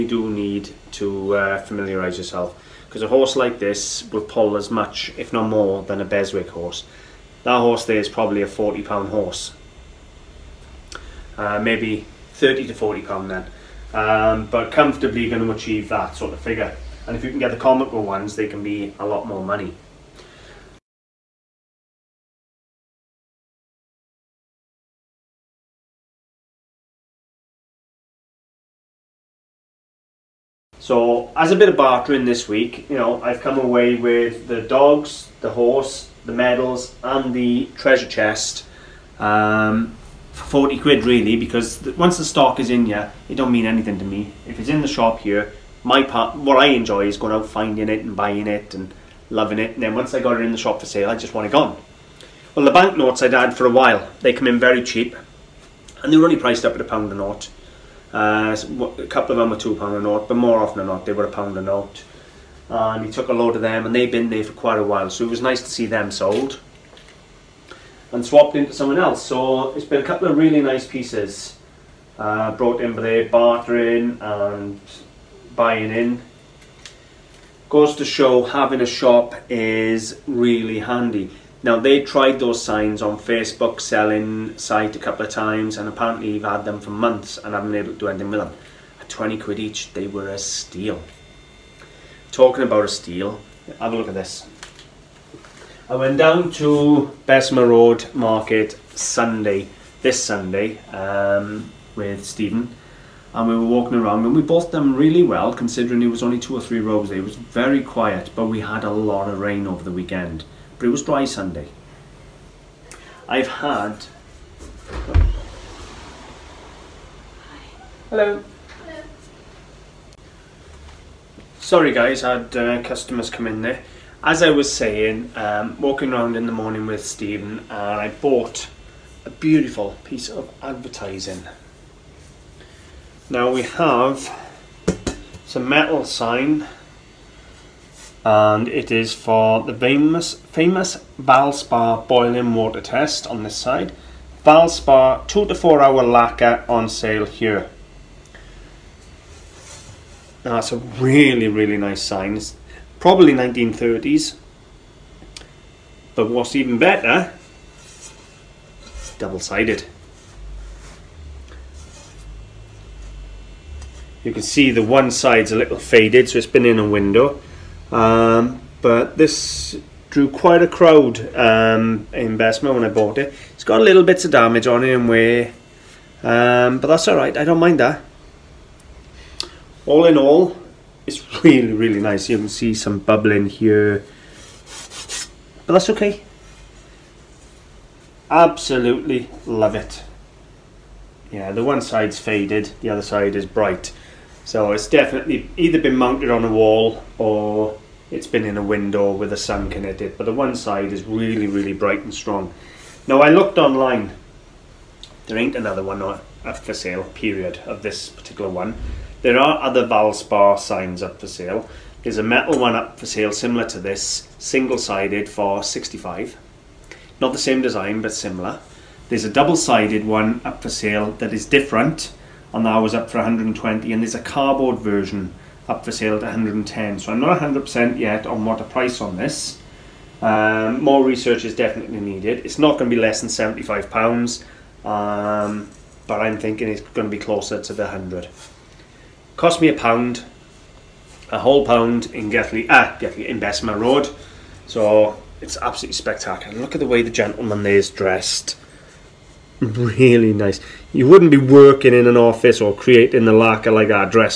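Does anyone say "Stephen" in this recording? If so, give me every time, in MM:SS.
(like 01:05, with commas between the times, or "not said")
01:42, 02:07.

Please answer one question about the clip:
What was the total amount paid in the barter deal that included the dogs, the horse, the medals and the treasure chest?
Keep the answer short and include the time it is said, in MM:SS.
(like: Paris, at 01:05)
£40, at 00:40.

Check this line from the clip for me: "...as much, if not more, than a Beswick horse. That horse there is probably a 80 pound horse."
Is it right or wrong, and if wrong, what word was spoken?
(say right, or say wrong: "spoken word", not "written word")
wrong: "40", not "80".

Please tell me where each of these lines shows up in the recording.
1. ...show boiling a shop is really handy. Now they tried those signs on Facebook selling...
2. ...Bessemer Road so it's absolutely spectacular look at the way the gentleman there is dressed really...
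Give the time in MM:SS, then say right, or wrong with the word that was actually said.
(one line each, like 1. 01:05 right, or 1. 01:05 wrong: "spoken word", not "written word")
1. 01:18 wrong: "having", not "boiling"
2. 04:03 right.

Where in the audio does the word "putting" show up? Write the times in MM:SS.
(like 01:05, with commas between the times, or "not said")
not said.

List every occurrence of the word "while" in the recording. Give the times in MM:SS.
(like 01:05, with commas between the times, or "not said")
00:53, 01:04.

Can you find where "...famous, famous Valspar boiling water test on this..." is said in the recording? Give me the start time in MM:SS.
02:19.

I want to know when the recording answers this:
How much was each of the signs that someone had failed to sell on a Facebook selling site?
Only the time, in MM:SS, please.
01:29.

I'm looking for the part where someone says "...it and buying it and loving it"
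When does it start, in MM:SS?
00:47.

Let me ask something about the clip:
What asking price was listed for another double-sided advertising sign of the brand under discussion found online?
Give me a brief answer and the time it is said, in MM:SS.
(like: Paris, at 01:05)
£120, at 03:43.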